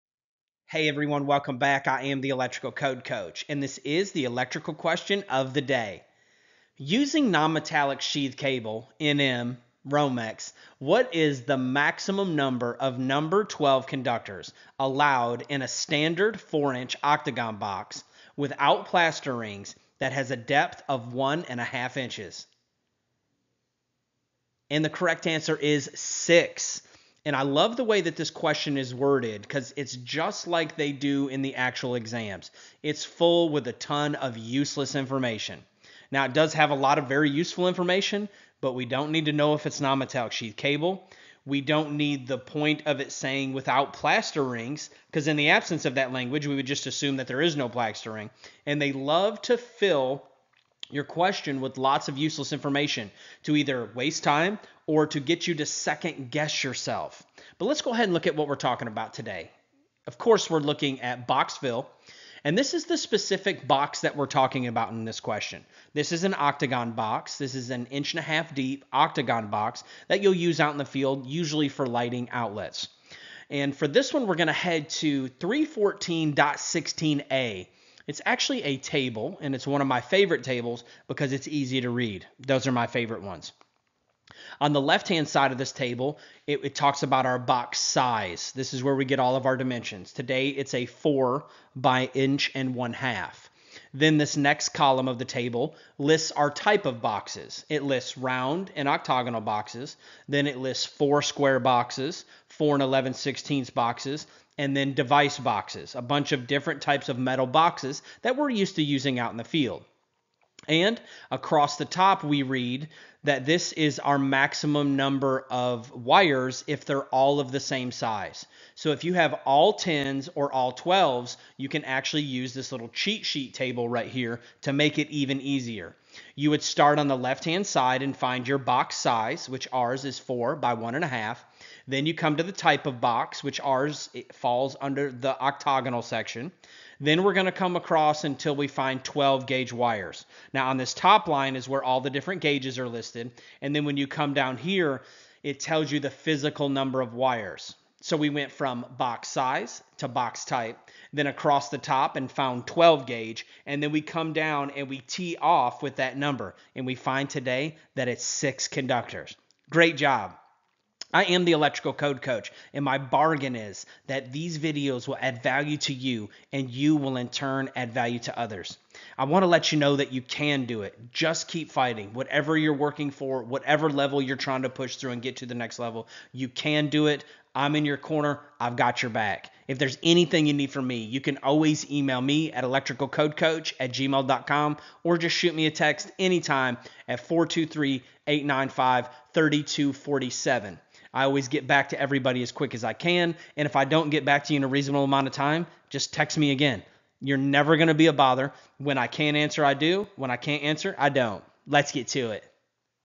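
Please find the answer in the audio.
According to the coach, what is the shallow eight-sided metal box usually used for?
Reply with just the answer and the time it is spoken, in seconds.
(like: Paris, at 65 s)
Lighting outlets, at 71 s.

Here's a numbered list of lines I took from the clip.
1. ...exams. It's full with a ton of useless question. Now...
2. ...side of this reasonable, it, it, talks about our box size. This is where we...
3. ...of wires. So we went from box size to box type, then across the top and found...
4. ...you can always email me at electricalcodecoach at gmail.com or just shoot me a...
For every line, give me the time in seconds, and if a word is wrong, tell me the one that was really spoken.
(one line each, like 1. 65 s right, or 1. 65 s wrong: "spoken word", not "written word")
1. 31 s wrong: "information", not "question"
2. 85 s wrong: "table", not "reasonable"
3. 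146 s right
4. 181 s right.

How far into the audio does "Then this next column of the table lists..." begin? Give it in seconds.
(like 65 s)
93 s.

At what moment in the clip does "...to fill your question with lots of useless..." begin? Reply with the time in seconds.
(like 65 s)
49 s.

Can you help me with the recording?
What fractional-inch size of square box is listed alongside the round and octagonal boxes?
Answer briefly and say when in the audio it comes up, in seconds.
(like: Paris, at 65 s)
4 and 11/16, at 102 s.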